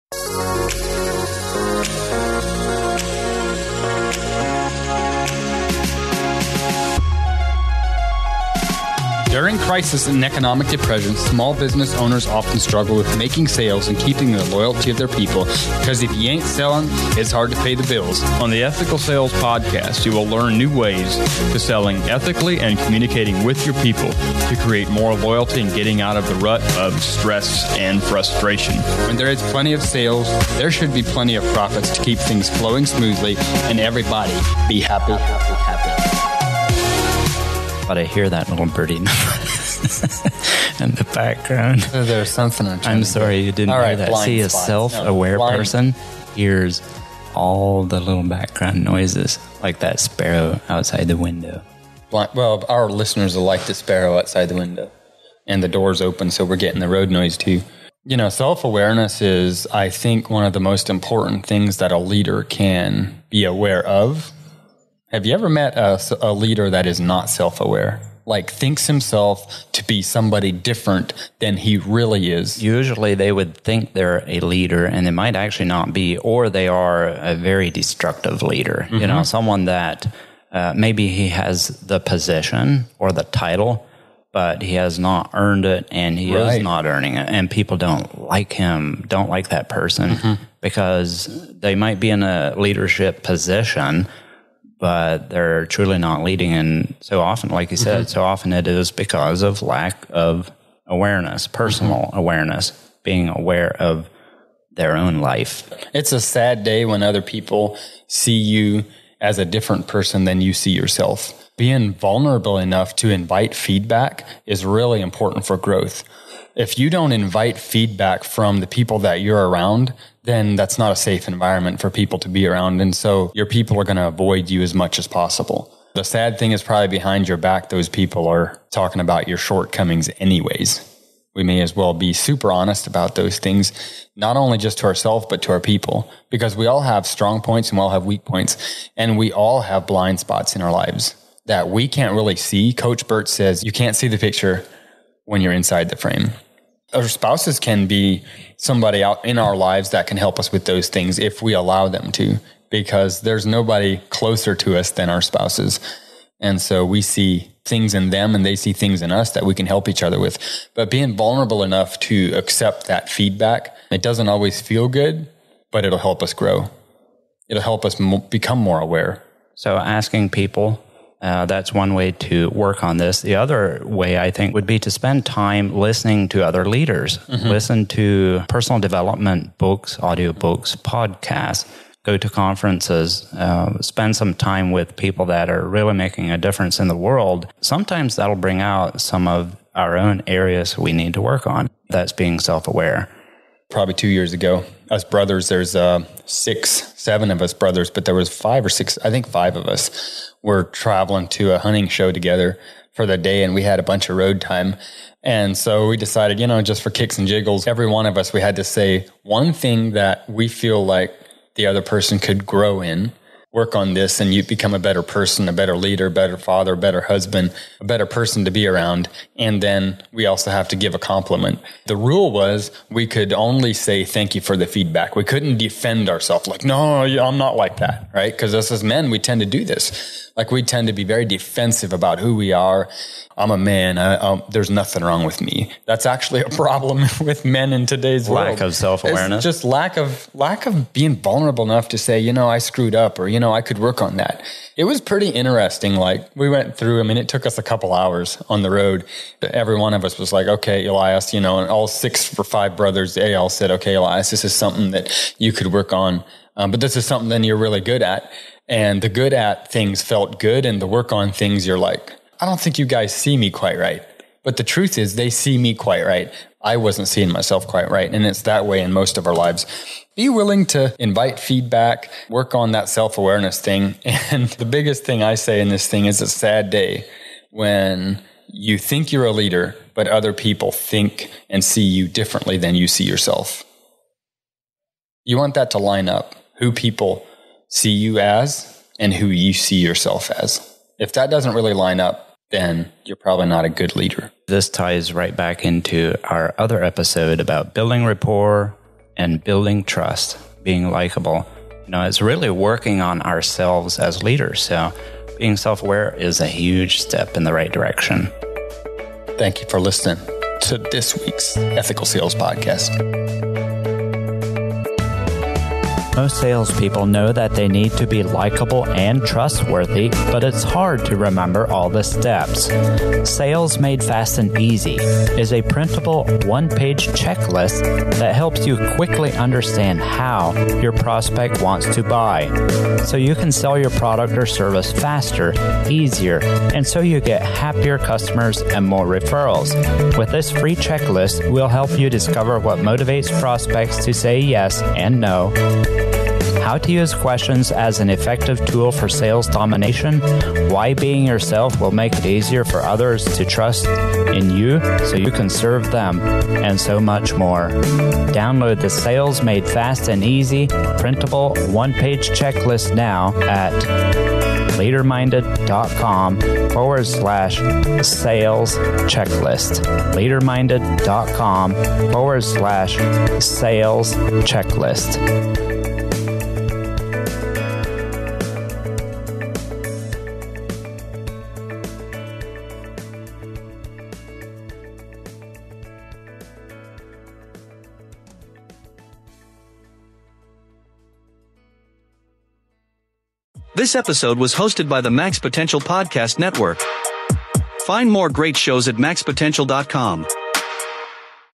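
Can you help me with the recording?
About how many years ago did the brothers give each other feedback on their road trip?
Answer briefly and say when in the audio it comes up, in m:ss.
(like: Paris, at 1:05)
2, at 3:13.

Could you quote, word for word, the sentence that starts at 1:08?
Like thinks himself to be somebody different than he really is.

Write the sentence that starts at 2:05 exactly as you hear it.
The sad thing is probably behind your back, those people are talking about your shortcomings anyways.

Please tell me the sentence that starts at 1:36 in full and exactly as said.
And so often, like you said, mm-hmm.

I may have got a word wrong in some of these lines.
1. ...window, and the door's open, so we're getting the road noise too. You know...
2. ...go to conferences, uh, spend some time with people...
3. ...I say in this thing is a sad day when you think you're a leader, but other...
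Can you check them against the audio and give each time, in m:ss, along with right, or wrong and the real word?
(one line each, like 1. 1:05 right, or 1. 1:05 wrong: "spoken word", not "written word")
1. 0:54 right
2. 3:02 right
3. 4:35 right.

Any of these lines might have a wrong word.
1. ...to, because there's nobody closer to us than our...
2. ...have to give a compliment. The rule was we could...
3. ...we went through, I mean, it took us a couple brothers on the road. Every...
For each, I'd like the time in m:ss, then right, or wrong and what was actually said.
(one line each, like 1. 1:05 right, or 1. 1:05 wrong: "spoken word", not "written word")
1. 2:32 right
2. 3:40 right
3. 4:06 wrong: "hours", not "brothers".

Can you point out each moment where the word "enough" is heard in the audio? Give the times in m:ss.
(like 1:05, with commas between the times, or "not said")
1:52, 2:41, 4:01.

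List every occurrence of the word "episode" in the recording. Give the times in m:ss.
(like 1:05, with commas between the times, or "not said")
4:56, 6:33.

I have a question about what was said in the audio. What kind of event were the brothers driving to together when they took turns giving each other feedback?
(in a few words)
A hunting show.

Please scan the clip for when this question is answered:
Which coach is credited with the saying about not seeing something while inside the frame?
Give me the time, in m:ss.
2:22.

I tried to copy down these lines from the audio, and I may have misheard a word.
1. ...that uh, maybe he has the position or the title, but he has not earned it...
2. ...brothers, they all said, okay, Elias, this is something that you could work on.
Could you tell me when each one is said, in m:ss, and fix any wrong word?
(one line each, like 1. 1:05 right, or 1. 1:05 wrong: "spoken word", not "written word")
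1. 1:19 right
2. 4:12 right.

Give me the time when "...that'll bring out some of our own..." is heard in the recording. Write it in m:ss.
3:08.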